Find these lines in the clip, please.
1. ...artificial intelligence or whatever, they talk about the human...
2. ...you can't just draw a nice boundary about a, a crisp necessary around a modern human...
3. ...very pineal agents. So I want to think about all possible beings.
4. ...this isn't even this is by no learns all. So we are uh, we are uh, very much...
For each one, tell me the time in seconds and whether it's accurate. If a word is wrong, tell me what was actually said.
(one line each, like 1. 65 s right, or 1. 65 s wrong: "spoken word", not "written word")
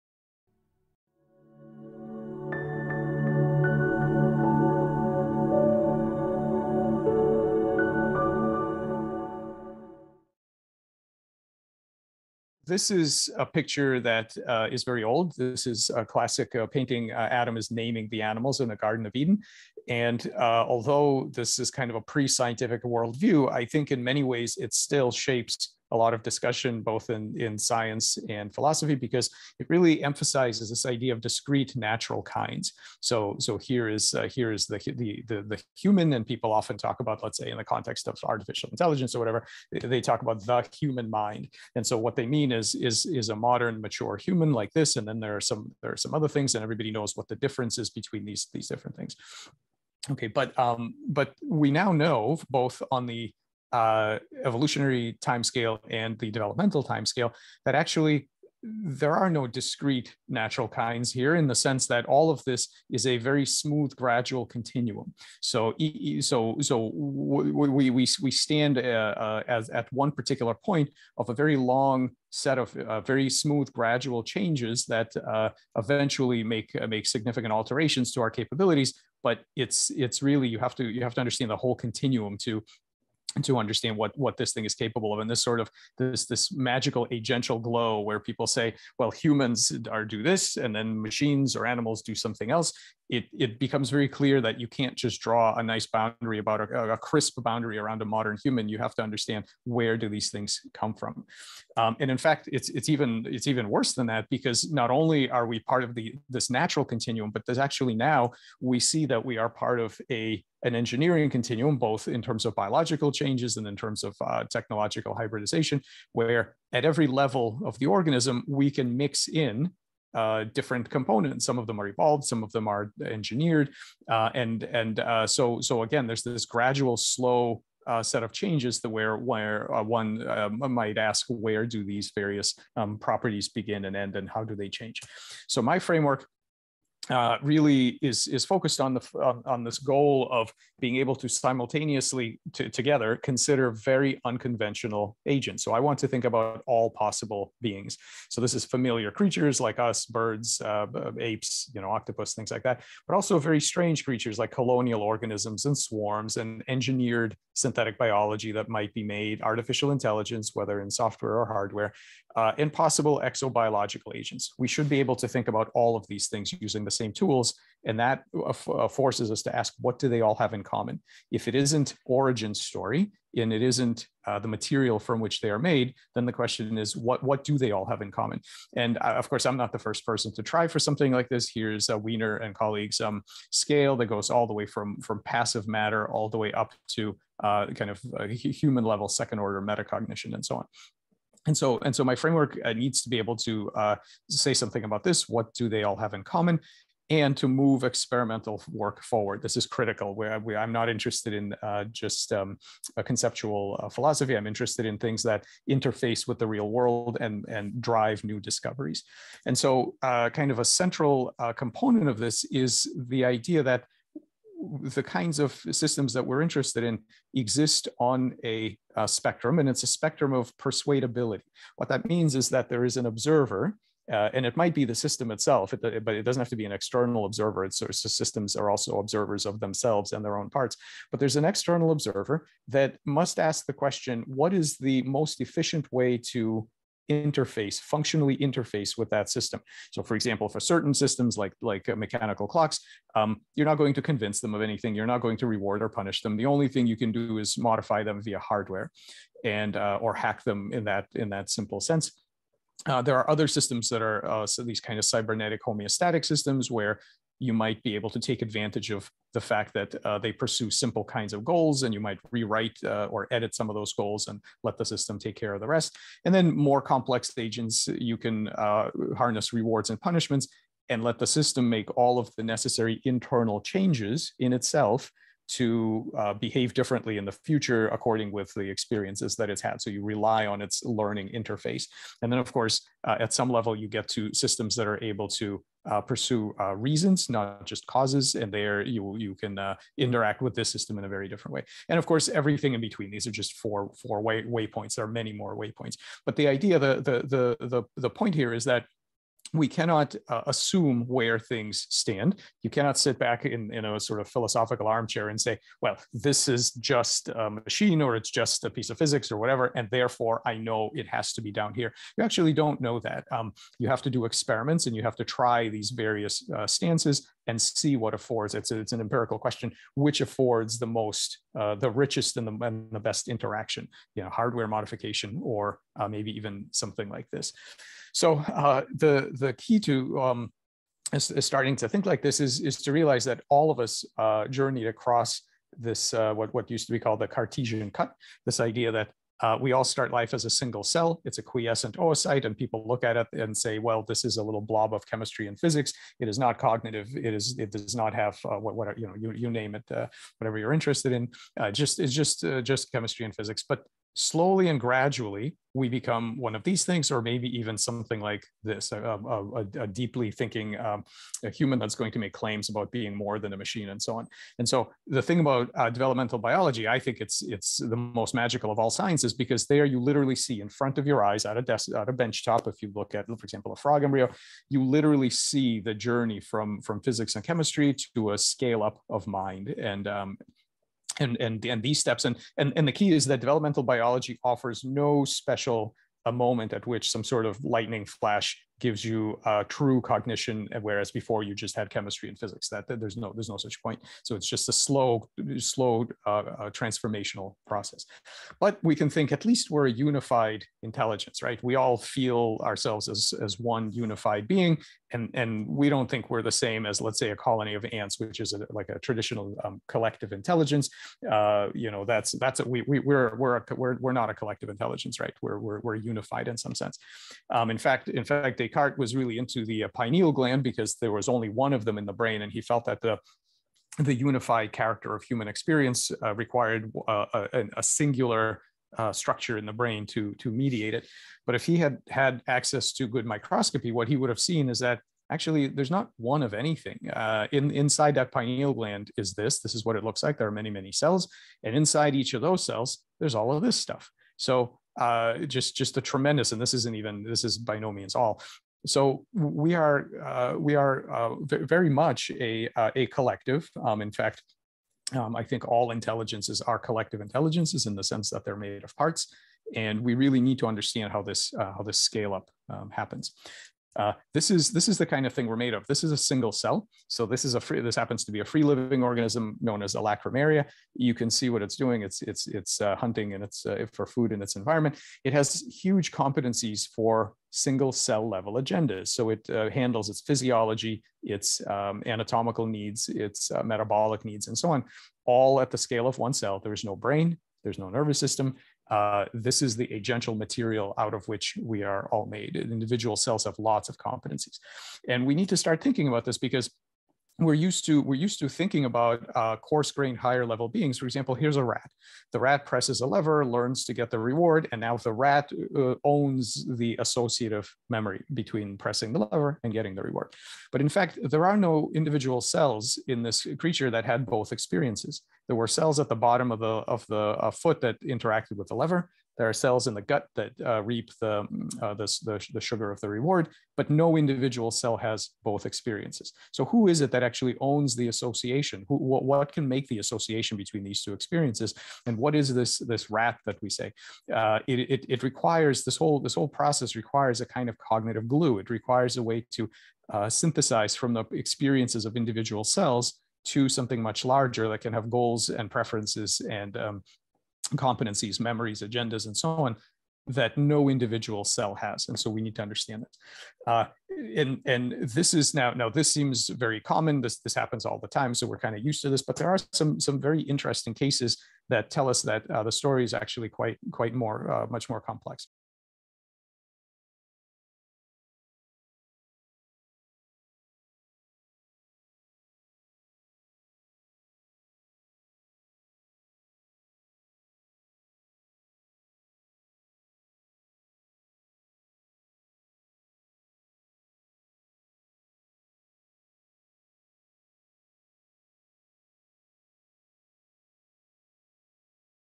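1. 38 s right
2. 94 s wrong: "boundary", not "necessary"
3. 143 s wrong: "unconventional", not "pineal"
4. 446 s wrong: "means", not "learns".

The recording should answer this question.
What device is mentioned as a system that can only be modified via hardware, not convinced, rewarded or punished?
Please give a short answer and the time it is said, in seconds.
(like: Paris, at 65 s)
mechanical clocks, at 241 s.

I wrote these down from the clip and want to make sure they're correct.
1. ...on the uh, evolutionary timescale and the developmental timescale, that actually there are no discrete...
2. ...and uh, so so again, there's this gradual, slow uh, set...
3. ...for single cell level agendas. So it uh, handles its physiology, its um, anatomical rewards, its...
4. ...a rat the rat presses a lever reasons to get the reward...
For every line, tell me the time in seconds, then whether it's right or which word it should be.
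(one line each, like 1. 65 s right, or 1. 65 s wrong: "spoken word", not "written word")
1. 52 s right
2. 124 s right
3. 476 s wrong: "needs", not "rewards"
4. 501 s wrong: "learns", not "reasons".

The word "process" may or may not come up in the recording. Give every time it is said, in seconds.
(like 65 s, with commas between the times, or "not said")
397 s, 536 s.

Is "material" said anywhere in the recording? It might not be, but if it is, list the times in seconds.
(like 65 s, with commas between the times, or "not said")
174 s, 490 s.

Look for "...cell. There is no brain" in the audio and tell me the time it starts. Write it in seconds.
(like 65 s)
486 s.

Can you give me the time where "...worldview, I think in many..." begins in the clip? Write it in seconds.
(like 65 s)
22 s.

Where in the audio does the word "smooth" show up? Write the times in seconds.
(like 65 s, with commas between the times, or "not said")
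63 s, 73 s.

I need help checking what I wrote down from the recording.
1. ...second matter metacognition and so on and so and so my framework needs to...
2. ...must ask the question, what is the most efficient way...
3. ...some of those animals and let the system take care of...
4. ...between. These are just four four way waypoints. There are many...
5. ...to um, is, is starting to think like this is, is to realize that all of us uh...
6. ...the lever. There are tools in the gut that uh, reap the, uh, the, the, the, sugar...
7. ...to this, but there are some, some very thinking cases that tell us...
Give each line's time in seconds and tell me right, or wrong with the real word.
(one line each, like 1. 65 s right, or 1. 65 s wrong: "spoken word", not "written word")
1. 189 s wrong: "order", not "matter"
2. 233 s right
3. 263 s wrong: "goals", not "animals"
4. 292 s right
5. 329 s right
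6. 518 s wrong: "cells", not "tools"
7. 559 s wrong: "interesting", not "thinking".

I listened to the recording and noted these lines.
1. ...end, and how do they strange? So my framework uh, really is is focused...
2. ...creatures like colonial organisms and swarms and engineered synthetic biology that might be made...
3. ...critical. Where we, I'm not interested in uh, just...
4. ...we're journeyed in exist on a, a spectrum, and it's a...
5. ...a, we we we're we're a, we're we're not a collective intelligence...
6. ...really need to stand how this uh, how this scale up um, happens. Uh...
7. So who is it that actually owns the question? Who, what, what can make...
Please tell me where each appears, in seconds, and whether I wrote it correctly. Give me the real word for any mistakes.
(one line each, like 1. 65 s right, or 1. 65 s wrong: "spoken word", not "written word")
1. 133 s wrong: "change", not "strange"
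2. 154 s right
3. 199 s right
4. 216 s wrong: "interested", not "journeyed"
5. 412 s right
6. 460 s wrong: "understand", not "stand"
7. 526 s wrong: "association", not "question".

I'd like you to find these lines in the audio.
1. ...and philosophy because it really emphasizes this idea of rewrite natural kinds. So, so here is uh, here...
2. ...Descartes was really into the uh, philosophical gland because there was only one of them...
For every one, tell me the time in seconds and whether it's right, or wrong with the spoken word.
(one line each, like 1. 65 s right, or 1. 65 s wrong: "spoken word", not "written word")
1. 28 s wrong: "discrete", not "rewrite"
2. 418 s wrong: "pineal", not "philosophical".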